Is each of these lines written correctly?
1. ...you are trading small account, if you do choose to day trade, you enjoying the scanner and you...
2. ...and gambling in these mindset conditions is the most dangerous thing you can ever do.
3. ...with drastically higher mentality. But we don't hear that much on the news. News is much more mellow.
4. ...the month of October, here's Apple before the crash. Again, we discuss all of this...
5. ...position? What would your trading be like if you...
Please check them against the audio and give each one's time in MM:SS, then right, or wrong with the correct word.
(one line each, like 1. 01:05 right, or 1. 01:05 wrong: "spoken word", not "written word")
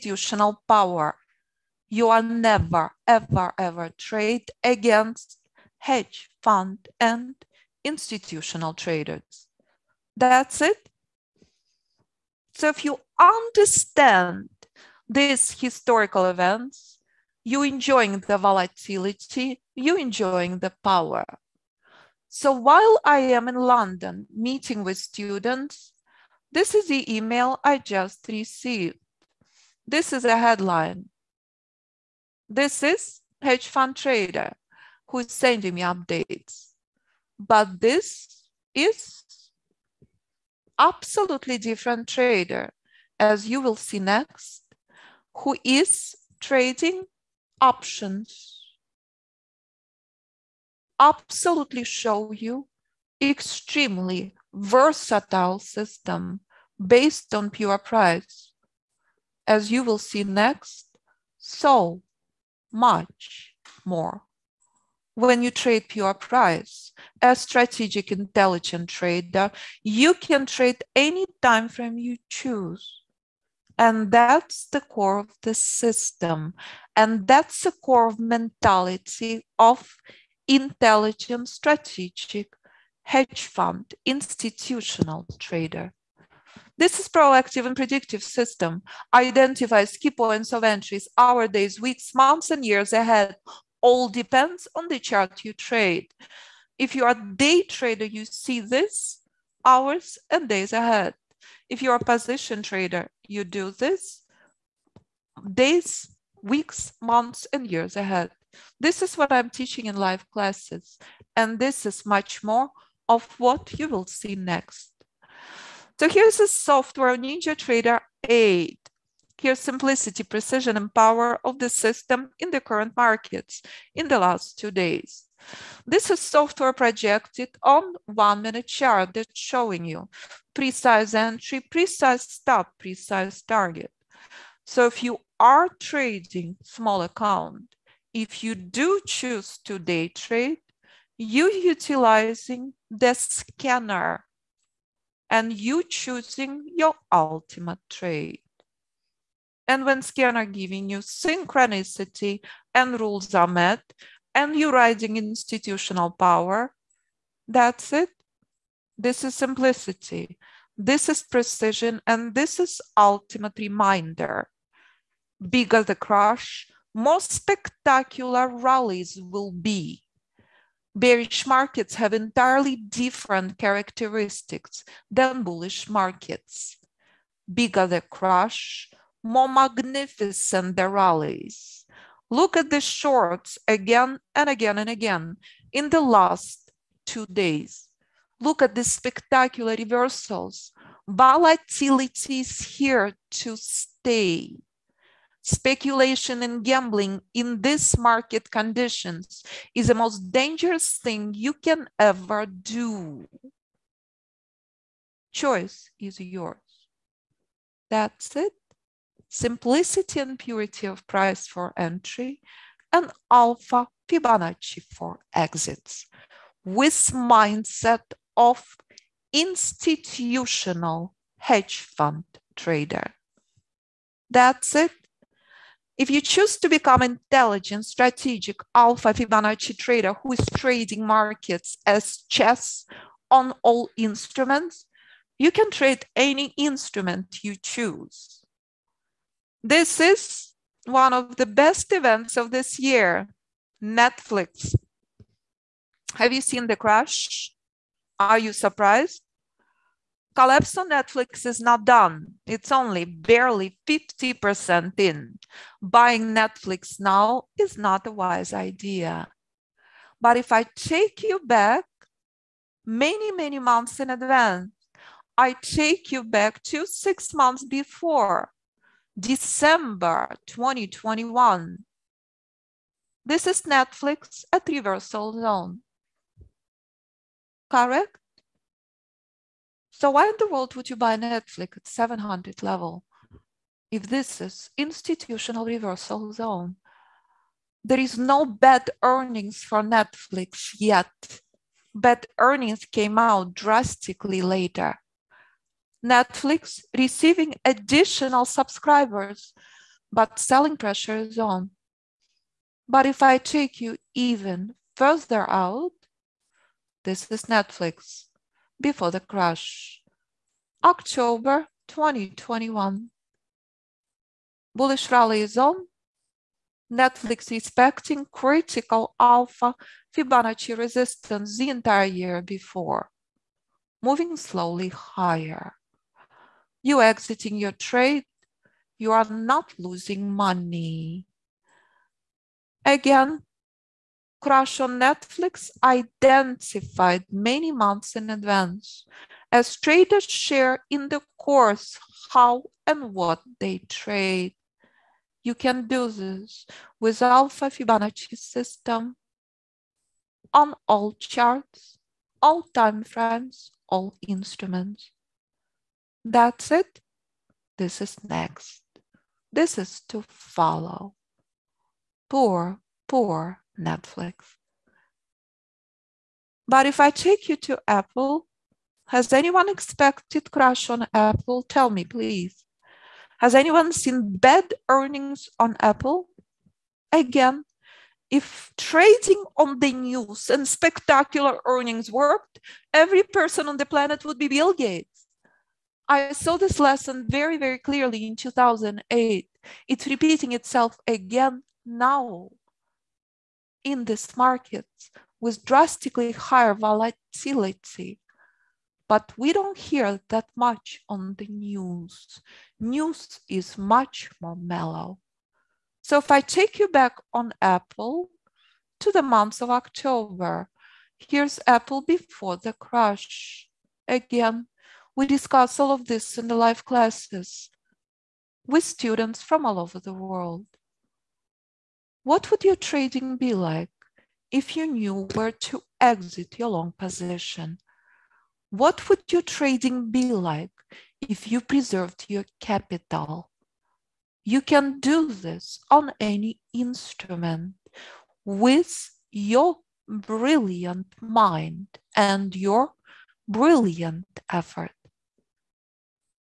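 1. 02:15 wrong: "utilizing", not "enjoying"
2. 03:16 wrong: "market", not "mindset"
3. 06:35 wrong: "volatility", not "mentality"
4. 06:49 right
5. 07:06 right.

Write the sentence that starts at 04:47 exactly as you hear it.
There is no bad earnings for Netflix yet.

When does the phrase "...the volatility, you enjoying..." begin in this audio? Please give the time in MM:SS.
00:18.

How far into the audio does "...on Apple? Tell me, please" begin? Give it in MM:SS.
06:10.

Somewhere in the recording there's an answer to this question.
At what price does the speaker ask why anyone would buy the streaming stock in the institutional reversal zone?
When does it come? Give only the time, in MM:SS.
04:41.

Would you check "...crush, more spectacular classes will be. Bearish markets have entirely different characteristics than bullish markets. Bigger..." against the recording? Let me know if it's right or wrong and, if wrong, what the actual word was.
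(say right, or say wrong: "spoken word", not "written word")
wrong: "rallies", not "classes".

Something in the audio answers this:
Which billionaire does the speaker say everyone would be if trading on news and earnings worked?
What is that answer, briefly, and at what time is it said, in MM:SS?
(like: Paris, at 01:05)
Bill Gates, at 06:24.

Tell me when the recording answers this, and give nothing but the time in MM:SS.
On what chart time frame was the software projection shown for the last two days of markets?
02:08.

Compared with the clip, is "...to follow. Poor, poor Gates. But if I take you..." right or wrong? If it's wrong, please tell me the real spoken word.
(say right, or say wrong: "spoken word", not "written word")
wrong: "Netflix", not "Gates".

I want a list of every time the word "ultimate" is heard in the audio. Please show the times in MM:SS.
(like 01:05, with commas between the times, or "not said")
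02:27, 02:42.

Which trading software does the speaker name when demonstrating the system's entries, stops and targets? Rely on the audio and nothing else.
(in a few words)
NinjaTrader 8.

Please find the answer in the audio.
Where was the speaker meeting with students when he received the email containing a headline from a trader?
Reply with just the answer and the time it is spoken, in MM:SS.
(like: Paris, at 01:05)
London, at 00:23.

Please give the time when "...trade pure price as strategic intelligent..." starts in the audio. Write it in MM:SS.
01:05.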